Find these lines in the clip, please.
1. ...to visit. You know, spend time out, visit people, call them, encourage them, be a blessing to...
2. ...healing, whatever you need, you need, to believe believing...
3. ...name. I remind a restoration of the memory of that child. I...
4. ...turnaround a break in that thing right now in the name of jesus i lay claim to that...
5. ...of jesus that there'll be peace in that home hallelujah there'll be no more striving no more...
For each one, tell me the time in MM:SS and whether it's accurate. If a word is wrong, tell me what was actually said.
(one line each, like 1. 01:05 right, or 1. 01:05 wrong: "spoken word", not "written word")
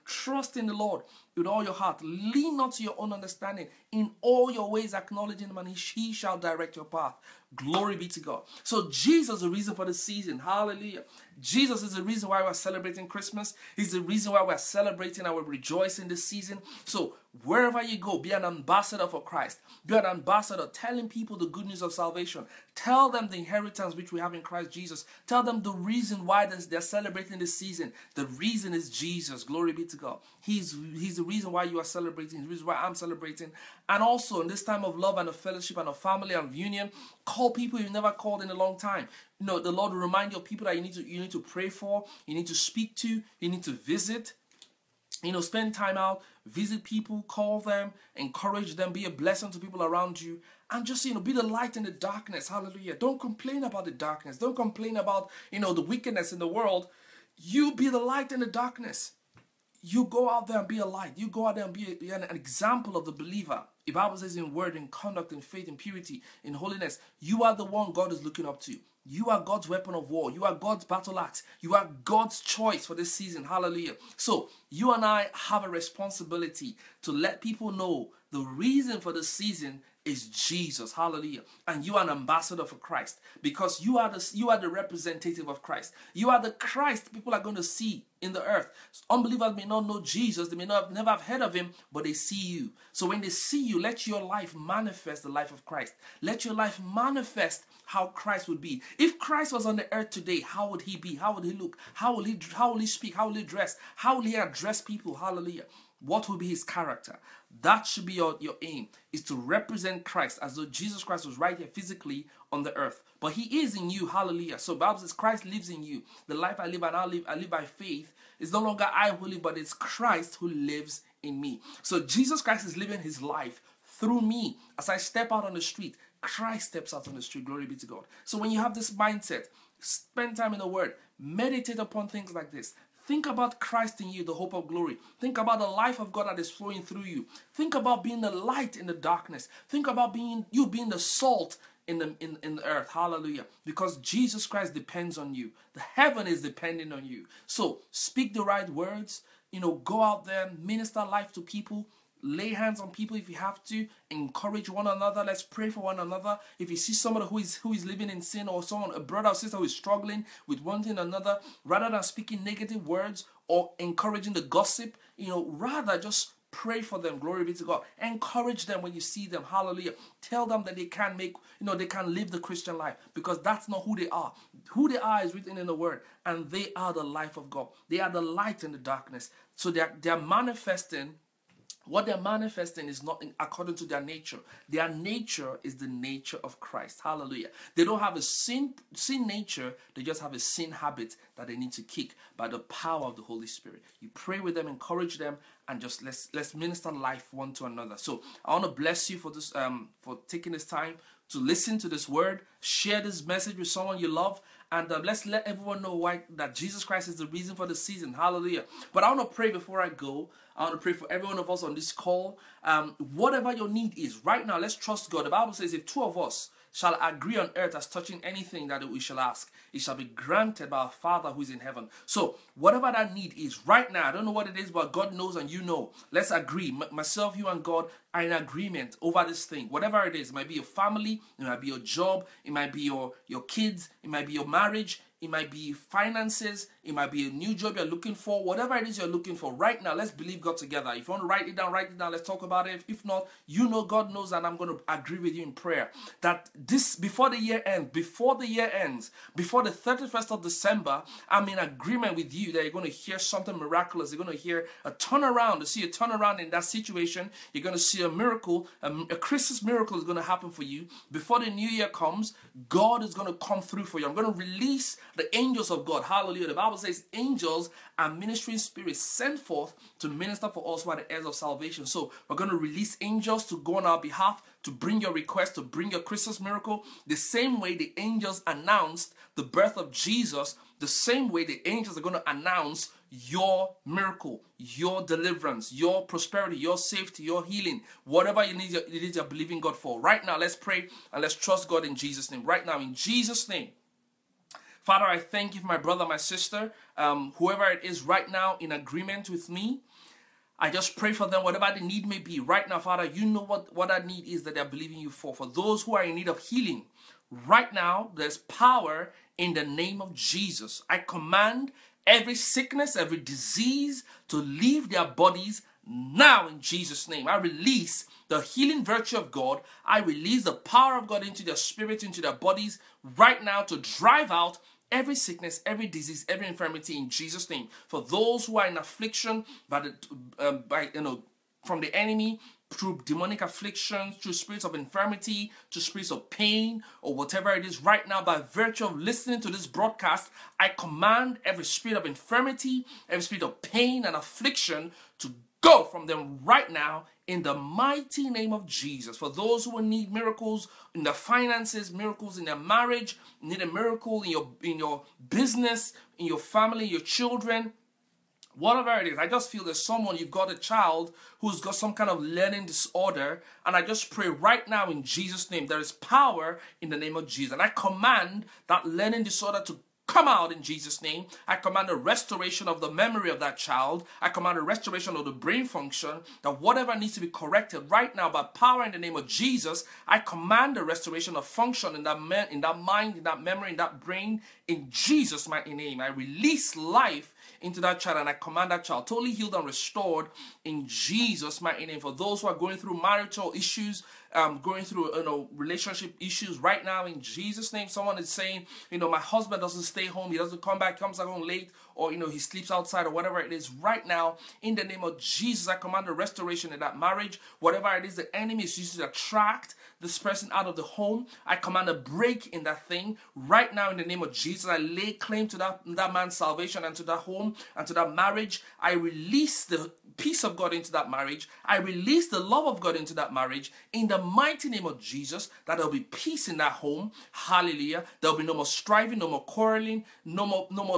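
1. 00:43 right
2. 04:47 right
3. 06:11 wrong: "command", not "remind"
4. 06:51 wrong: "command", not "turnaround"
5. 07:04 right.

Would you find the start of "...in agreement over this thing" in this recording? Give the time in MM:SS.
03:48.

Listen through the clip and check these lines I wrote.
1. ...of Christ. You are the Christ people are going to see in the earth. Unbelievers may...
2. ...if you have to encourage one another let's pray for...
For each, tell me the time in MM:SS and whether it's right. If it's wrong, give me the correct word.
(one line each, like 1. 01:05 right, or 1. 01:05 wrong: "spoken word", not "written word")
1. 01:25 right
2. 02:33 right.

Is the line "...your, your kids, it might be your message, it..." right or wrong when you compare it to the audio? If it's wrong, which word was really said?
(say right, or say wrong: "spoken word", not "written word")
wrong: "marriage", not "message".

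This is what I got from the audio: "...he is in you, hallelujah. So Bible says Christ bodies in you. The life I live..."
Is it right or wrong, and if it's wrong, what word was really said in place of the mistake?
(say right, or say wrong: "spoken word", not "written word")
wrong: "lives", not "bodies".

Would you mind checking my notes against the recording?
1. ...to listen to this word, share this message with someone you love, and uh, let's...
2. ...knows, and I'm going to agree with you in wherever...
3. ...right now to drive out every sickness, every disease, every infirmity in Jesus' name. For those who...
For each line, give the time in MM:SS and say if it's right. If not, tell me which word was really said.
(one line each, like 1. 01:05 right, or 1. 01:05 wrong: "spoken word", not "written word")
1. 03:21 right
2. 04:04 wrong: "prayer", not "wherever"
3. 05:23 right.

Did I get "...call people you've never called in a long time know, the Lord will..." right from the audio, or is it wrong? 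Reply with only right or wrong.
right.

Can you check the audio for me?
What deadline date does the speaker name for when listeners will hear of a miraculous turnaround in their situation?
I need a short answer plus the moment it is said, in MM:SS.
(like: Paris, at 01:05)
31st of December, at 04:09.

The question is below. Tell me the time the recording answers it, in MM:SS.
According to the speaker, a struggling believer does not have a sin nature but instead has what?
03:10.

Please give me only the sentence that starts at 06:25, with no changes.
I release life into that child and I command that child totally healed and restored in Jesus' mighty name.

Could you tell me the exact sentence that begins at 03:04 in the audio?
Their nature is the nature of Christ.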